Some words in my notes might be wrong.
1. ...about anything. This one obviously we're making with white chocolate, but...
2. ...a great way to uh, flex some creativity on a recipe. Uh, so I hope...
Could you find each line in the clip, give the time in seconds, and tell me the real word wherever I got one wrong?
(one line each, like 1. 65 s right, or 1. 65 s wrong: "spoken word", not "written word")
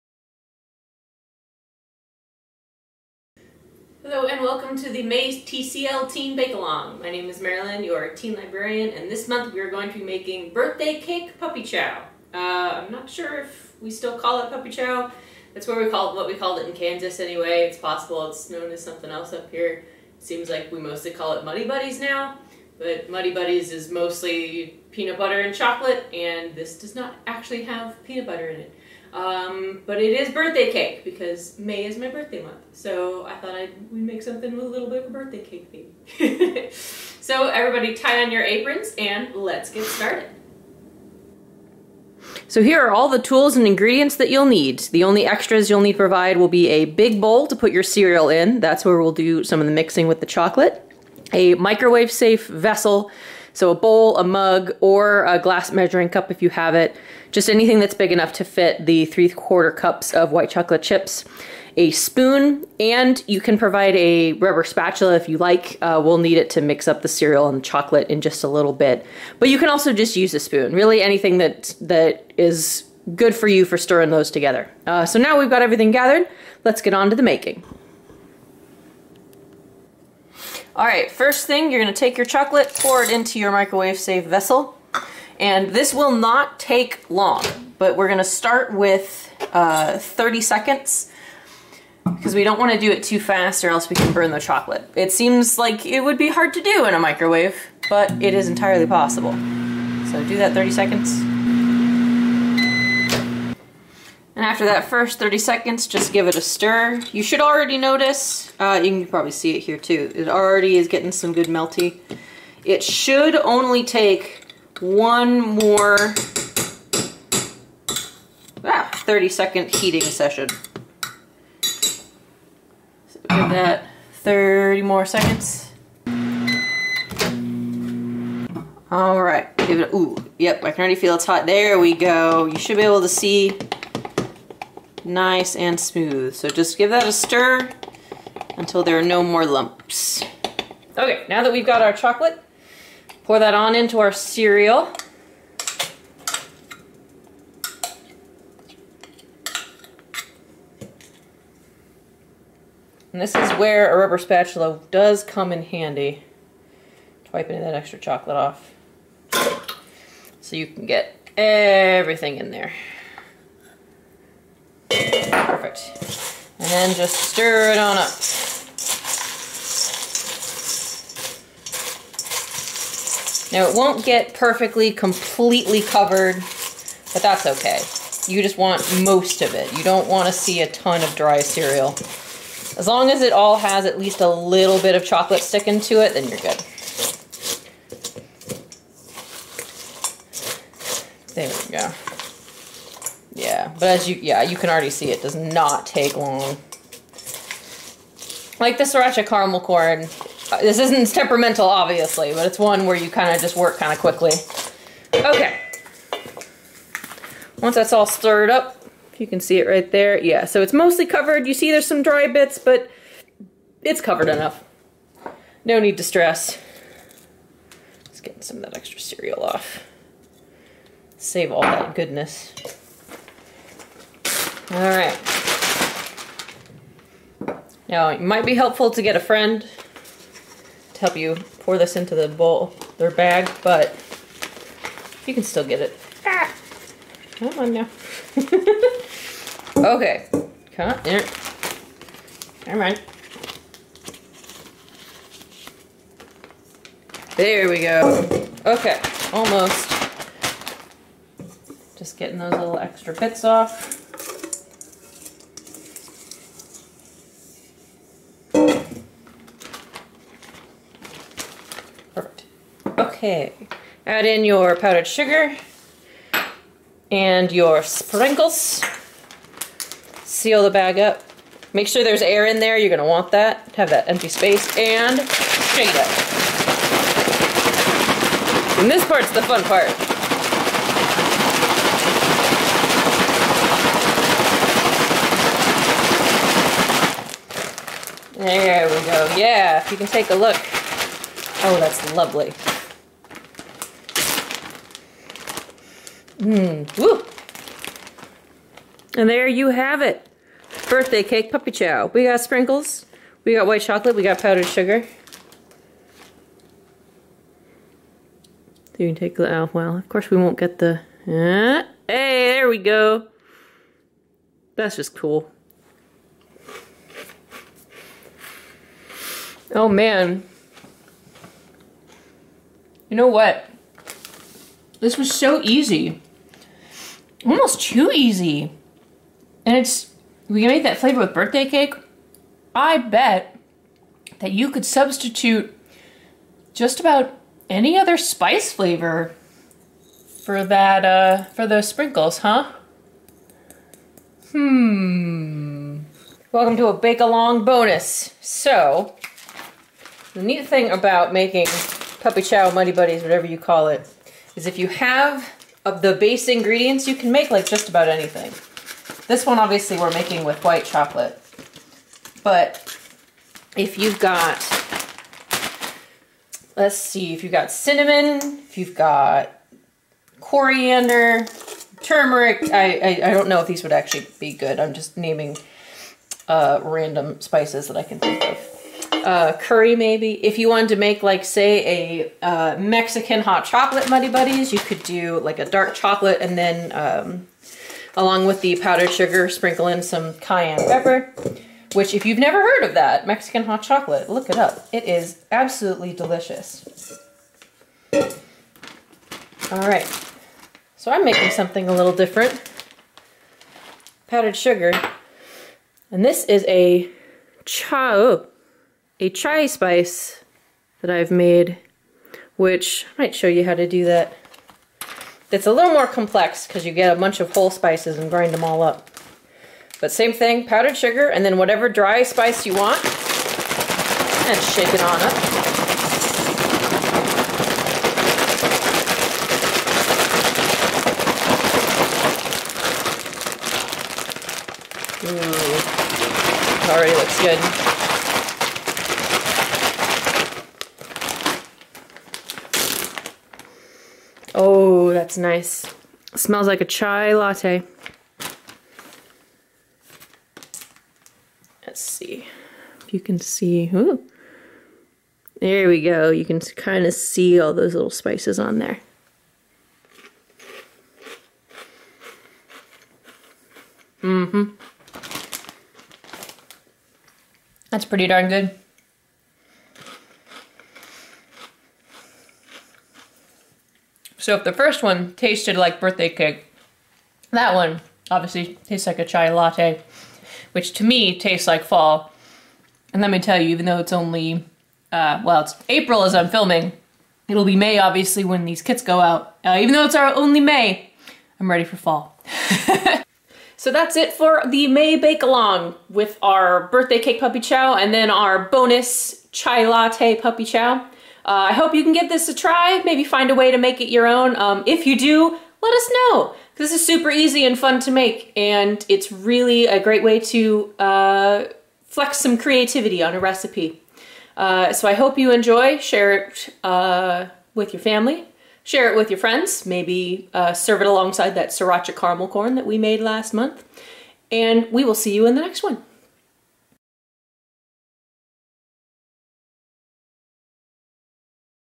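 1. 357 s right
2. 509 s right.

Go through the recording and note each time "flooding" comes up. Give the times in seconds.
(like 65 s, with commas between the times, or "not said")
not said.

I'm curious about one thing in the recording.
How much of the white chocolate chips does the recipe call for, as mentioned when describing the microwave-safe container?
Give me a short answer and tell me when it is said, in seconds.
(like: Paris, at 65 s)
3/4 cup, at 59 s.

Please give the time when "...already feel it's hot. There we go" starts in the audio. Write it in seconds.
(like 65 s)
130 s.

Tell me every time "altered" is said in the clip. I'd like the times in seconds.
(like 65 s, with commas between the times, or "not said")
not said.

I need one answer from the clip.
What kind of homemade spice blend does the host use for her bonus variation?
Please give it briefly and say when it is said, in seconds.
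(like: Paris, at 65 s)
chai spice, at 409 s.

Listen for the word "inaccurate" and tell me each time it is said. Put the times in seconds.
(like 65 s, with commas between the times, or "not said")
not said.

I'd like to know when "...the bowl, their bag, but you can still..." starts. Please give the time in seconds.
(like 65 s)
232 s.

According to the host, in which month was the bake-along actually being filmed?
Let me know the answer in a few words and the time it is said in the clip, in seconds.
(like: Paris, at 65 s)
April, at 485 s.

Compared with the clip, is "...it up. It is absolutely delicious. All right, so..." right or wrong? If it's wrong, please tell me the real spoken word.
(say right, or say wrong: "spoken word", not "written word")
right.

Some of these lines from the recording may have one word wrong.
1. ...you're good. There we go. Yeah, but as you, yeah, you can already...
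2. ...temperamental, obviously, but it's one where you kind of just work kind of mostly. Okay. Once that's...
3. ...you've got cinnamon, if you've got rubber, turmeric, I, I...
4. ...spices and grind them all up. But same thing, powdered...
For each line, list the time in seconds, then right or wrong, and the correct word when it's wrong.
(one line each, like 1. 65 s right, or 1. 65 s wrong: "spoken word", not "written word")
1. 186 s right
2. 201 s wrong: "quickly", not "mostly"
3. 367 s wrong: "coriander", not "rubber"
4. 417 s right.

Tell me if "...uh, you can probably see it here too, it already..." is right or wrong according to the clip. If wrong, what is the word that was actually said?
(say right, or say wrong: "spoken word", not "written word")
right.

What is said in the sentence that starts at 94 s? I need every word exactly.
It seems like it would be hard to do in a microwave, but it is entirely possible.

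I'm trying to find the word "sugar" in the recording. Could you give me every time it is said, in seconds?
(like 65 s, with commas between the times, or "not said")
265 s, 304 s, 389 s, 404 s, 420 s.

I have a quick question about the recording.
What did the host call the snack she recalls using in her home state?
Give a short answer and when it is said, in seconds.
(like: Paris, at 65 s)
Kansas, at 16 s.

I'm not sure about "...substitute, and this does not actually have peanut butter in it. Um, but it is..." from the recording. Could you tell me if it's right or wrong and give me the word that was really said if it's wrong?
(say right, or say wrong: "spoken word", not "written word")
wrong: "chocolate", not "substitute".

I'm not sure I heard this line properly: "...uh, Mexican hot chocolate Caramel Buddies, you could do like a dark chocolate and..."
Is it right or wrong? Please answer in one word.
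wrong.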